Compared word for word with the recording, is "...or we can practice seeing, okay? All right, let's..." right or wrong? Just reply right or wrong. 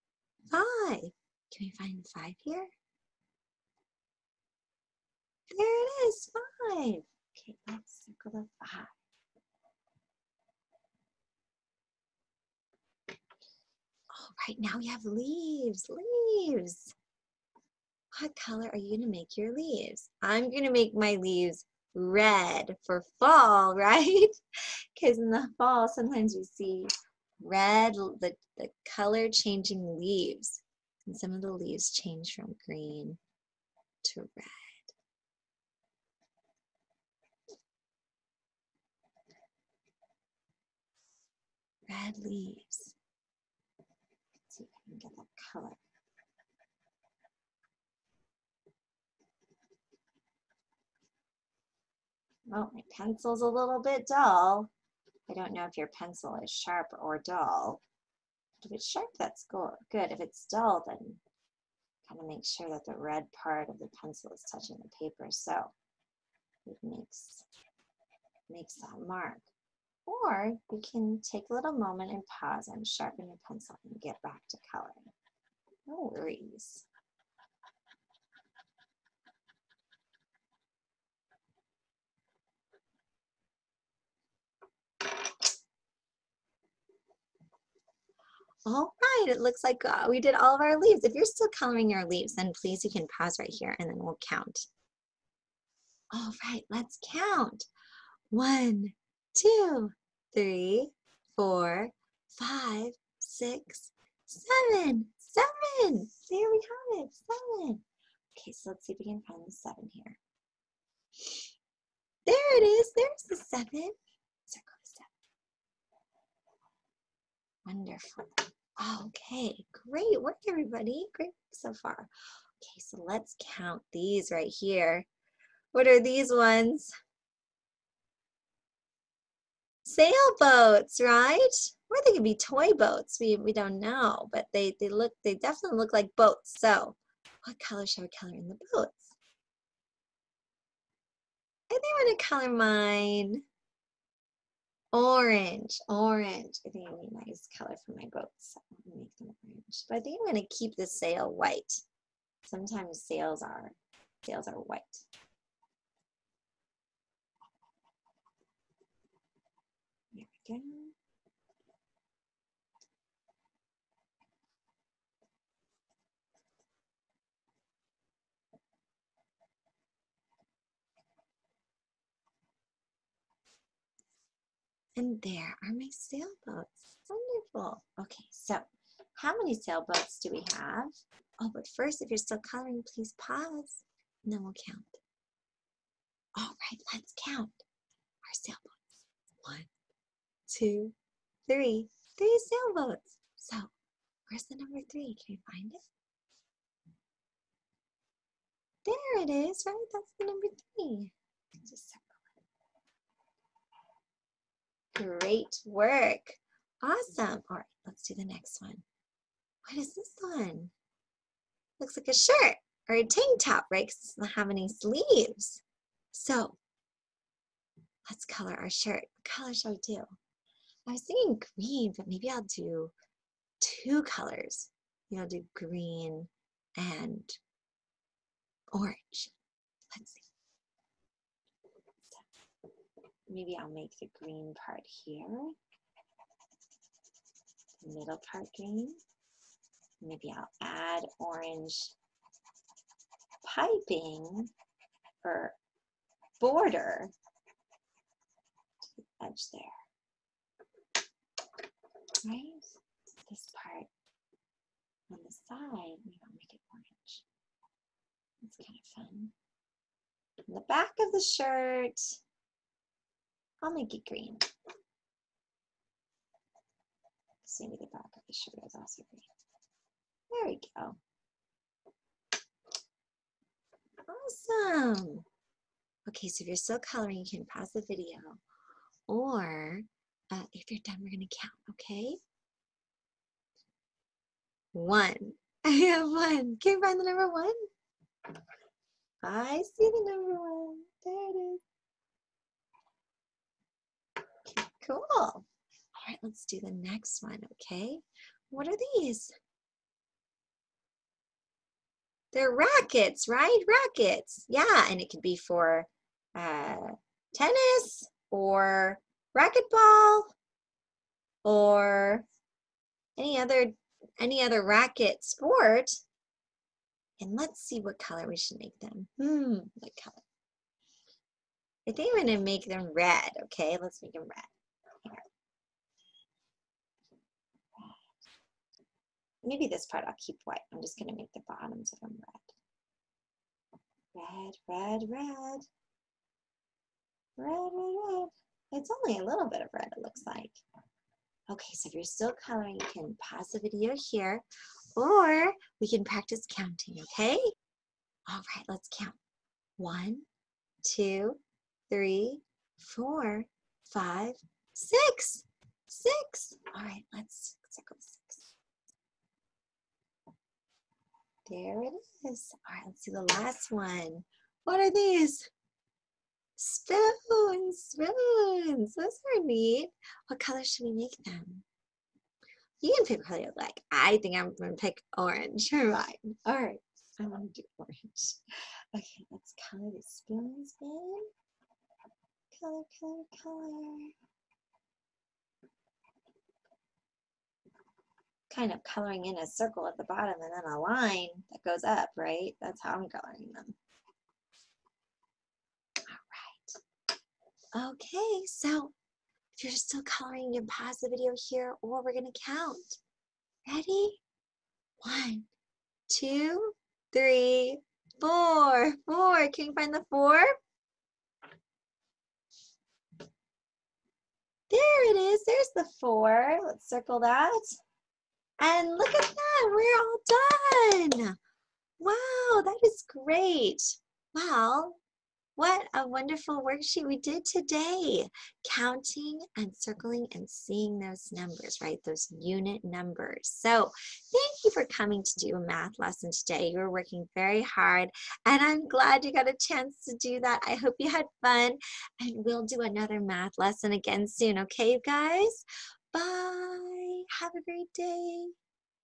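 wrong.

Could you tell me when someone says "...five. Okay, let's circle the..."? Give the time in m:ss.
0:06.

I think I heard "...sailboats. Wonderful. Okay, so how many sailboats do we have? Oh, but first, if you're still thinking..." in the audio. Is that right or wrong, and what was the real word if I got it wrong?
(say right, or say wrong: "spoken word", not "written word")
wrong: "coloring", not "thinking".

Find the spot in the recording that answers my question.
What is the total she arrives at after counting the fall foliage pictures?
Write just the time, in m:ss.
1:46.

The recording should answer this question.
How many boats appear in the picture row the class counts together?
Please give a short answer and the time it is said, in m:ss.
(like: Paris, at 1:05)
3, at 3:12.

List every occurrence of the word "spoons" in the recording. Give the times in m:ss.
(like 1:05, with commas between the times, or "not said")
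6:07, 6:20.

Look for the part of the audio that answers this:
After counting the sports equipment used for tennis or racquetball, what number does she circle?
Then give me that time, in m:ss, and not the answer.
5:54.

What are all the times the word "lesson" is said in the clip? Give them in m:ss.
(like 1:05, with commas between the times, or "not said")
7:15, 7:23.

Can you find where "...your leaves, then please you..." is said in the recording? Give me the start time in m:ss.
1:31.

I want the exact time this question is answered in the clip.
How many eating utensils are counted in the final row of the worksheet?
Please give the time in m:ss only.
6:48.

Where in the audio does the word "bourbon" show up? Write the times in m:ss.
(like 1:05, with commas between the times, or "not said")
not said.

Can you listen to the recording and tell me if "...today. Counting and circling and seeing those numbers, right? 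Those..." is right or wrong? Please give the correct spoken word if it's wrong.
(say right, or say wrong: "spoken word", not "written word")
right.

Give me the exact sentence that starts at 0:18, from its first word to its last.
What color are you gonna make your leaves?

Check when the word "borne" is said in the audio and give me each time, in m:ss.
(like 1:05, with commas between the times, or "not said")
not said.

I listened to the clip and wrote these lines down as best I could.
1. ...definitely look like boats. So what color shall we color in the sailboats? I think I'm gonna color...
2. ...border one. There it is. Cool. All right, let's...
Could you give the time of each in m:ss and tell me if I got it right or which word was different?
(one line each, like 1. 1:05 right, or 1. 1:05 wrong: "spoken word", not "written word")
1. 2:15 wrong: "boats", not "sailboats"
2. 4:50 wrong: "number", not "border".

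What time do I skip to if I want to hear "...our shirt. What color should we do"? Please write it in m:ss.
3:38.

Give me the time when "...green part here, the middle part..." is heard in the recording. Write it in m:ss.
3:54.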